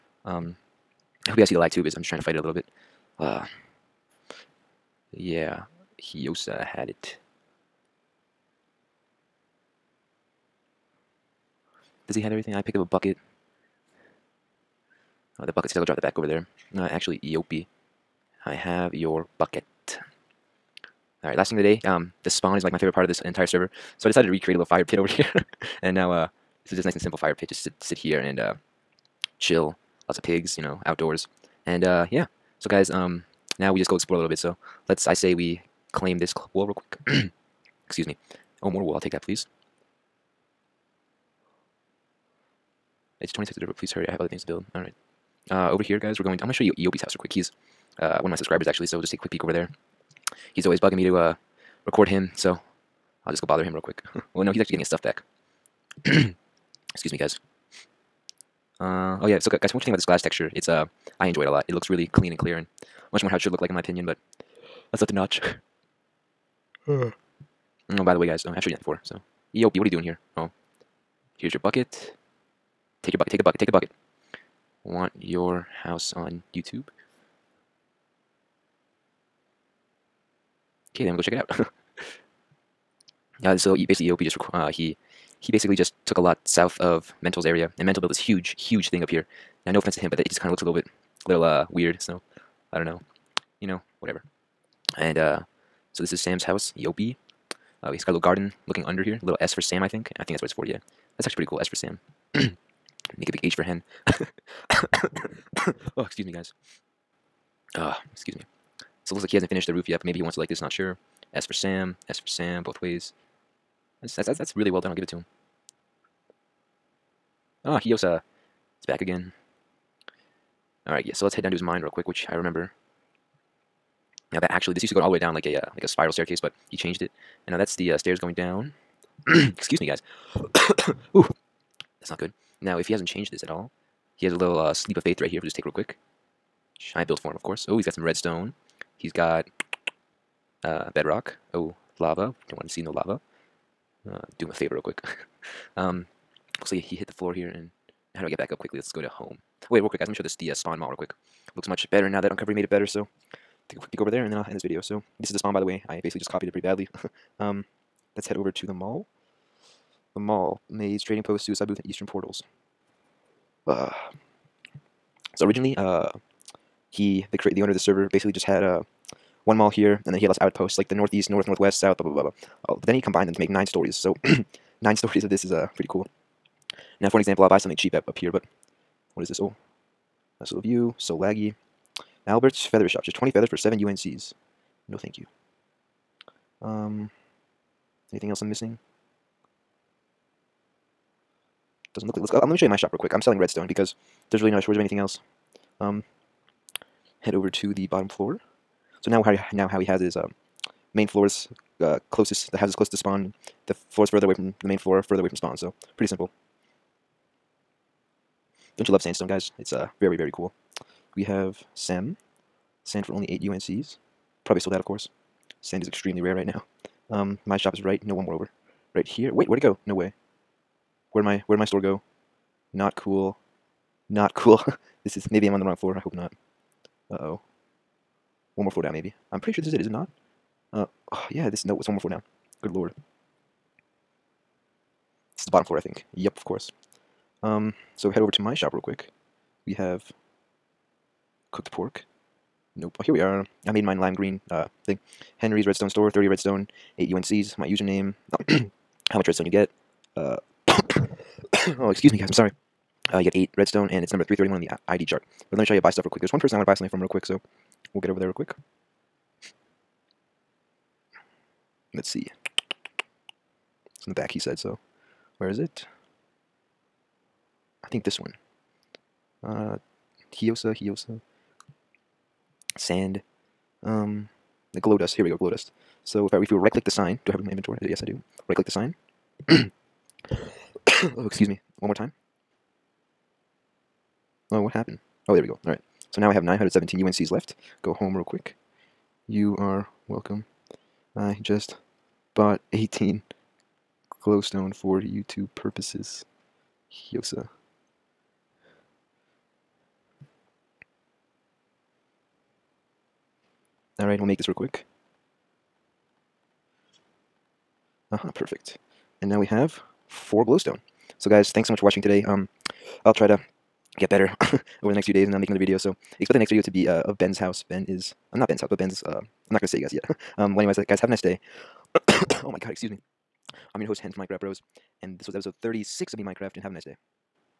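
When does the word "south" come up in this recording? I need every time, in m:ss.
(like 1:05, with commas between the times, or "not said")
1:26, 2:51.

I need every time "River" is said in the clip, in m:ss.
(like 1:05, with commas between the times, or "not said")
0:43.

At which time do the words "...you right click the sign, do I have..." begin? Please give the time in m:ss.
4:36.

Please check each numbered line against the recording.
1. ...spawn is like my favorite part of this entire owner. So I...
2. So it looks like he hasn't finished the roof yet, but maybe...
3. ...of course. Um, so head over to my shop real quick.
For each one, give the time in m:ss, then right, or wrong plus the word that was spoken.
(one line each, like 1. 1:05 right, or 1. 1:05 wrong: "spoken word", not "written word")
1. 0:22 wrong: "server", not "owner"
2. 1:49 right
3. 3:56 right.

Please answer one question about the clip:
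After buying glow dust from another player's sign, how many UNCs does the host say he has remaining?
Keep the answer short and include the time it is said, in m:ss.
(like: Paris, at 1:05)
917, at 4:46.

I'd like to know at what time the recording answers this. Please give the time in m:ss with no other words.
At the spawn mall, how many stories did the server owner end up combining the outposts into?
2:53.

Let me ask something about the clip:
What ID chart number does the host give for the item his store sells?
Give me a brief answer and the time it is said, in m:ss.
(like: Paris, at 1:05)
331, at 4:14.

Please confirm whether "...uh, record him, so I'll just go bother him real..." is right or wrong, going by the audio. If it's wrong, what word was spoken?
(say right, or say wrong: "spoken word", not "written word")
right.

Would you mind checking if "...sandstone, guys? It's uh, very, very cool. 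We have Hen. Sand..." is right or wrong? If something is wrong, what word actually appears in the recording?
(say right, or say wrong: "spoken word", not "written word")
wrong: "Sam", not "Hen".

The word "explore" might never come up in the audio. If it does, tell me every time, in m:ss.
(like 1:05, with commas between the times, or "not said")
0:33.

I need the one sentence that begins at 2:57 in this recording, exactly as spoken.
Now for an example, I'll buy something cheap up, up here, but what is this?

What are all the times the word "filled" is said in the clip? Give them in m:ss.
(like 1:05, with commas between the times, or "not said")
not said.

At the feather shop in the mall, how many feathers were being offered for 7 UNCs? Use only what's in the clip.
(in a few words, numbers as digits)
20.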